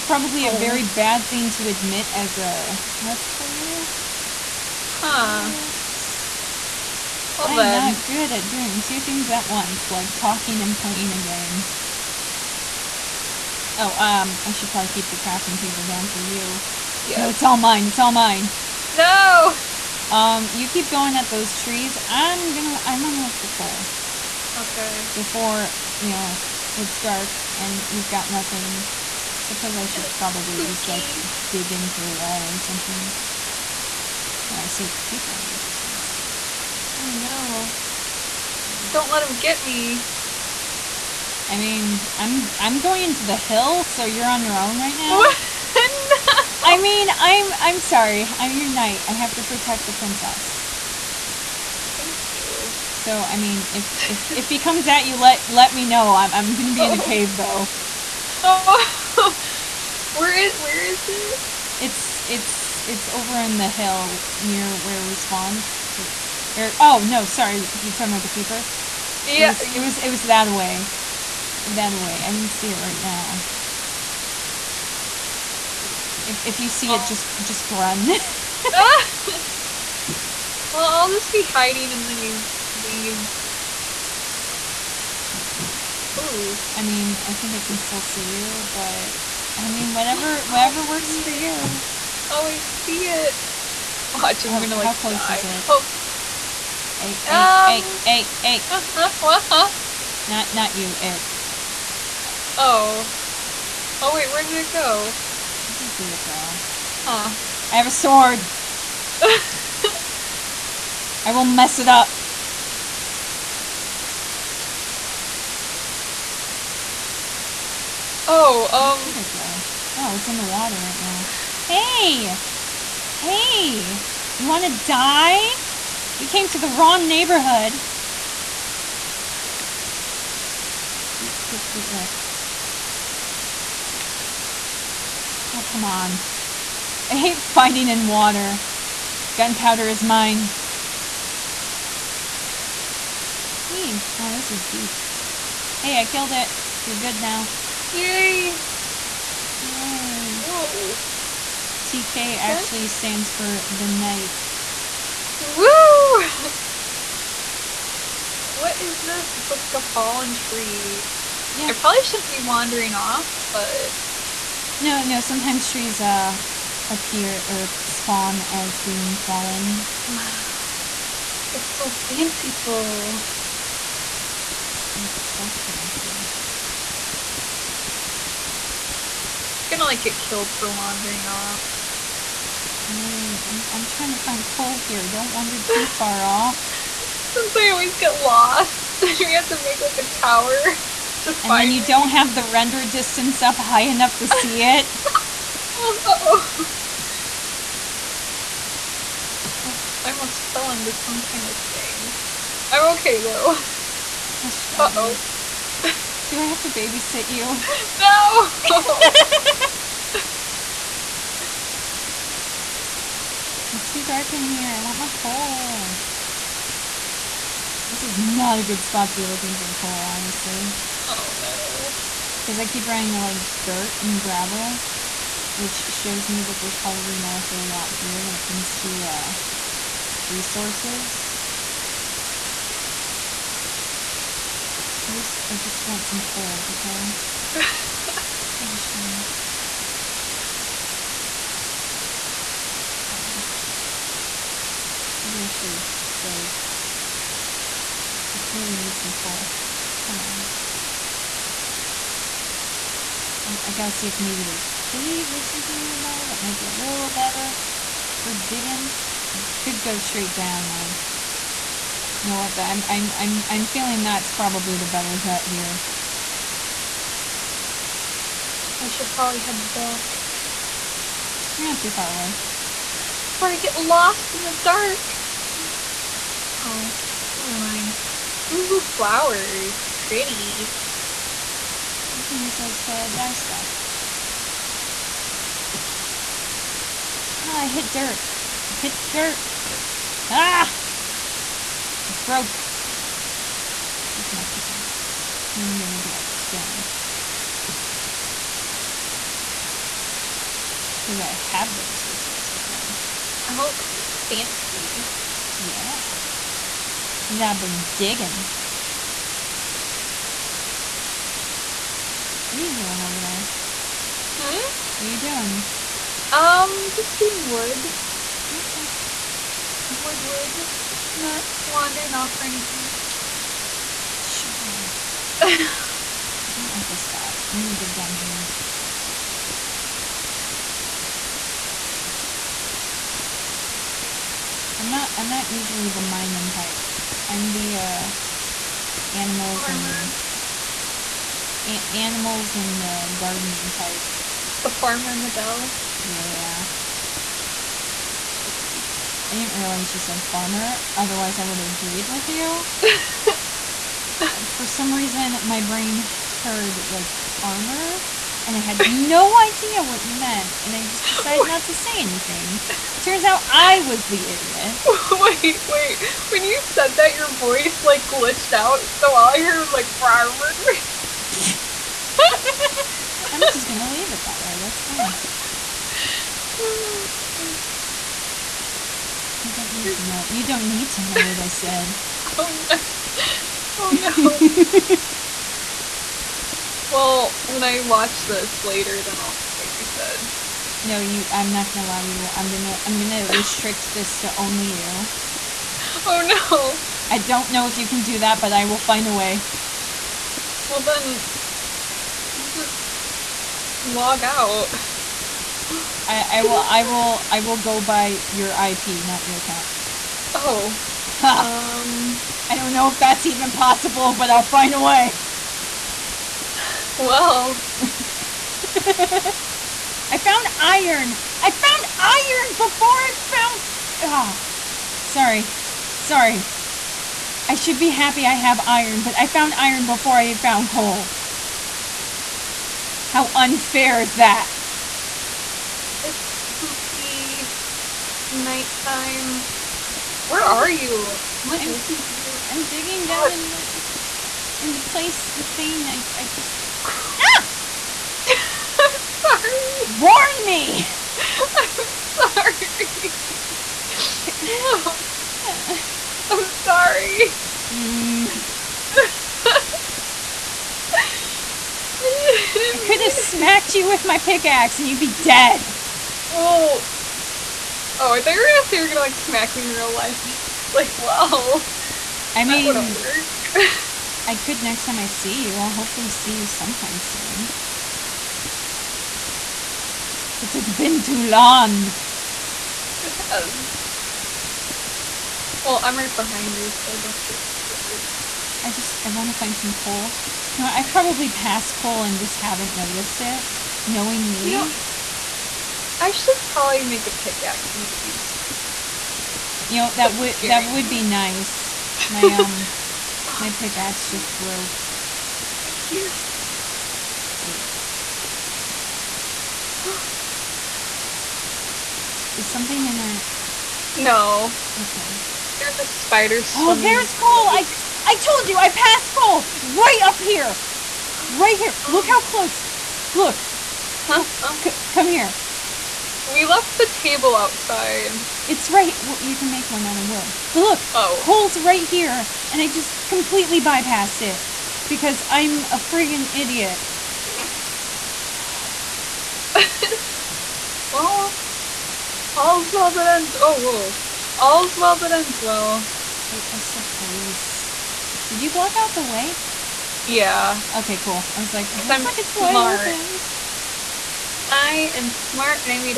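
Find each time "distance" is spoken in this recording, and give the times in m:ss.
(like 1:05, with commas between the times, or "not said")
0:35, 3:12.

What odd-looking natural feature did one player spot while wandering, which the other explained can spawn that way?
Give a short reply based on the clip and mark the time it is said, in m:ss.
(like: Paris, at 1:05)
A fallen tree, at 2:39.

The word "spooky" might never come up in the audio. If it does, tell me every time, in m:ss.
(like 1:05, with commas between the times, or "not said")
0:30, 7:16.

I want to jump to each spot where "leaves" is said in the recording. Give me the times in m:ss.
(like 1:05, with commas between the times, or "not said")
1:22, 6:13.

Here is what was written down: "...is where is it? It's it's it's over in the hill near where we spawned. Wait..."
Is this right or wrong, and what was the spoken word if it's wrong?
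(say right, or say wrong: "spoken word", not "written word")
right.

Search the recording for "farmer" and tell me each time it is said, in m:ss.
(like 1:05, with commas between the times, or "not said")
5:39, 5:44, 5:50.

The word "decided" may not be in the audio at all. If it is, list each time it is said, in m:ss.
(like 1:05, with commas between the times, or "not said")
6:01.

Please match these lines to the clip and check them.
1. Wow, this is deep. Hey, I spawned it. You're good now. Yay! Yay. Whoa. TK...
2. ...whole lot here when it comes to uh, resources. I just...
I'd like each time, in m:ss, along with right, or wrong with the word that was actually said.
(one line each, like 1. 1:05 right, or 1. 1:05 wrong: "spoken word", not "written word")
1. 2:24 wrong: "killed", not "spawned"
2. 3:47 right.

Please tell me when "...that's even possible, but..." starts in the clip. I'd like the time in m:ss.
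6:52.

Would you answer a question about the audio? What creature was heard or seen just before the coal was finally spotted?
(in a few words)
A spider.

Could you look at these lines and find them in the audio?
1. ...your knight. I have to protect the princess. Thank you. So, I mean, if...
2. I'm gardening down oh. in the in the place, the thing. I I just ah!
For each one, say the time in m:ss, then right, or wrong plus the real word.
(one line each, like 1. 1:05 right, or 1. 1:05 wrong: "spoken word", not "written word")
1. 0:48 right
2. 7:22 wrong: "digging", not "gardening".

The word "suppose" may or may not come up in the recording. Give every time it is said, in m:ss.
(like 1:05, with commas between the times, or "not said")
0:29, 9:06.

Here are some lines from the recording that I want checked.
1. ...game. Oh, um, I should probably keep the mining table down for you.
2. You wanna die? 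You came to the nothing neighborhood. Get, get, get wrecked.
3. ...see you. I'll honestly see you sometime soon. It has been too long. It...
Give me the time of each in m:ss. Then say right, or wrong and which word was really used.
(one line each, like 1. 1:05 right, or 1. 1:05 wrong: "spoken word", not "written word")
1. 0:11 wrong: "crafting", not "mining"
2. 2:04 wrong: "wrong", not "nothing"
3. 7:55 wrong: "hopefully", not "honestly".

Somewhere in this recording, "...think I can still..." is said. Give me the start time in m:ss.
1:27.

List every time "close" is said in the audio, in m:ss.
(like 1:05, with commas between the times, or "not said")
1:34, 8:42.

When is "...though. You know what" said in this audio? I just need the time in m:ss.
4:20.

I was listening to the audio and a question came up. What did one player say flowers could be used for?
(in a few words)
To dye stuff.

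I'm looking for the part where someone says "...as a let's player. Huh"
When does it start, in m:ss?
0:02.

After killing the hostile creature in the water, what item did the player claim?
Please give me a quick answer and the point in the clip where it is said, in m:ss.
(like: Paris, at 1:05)
Gunpowder, at 2:19.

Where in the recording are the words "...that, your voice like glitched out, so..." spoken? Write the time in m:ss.
6:06.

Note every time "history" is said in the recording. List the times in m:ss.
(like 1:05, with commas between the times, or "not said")
not said.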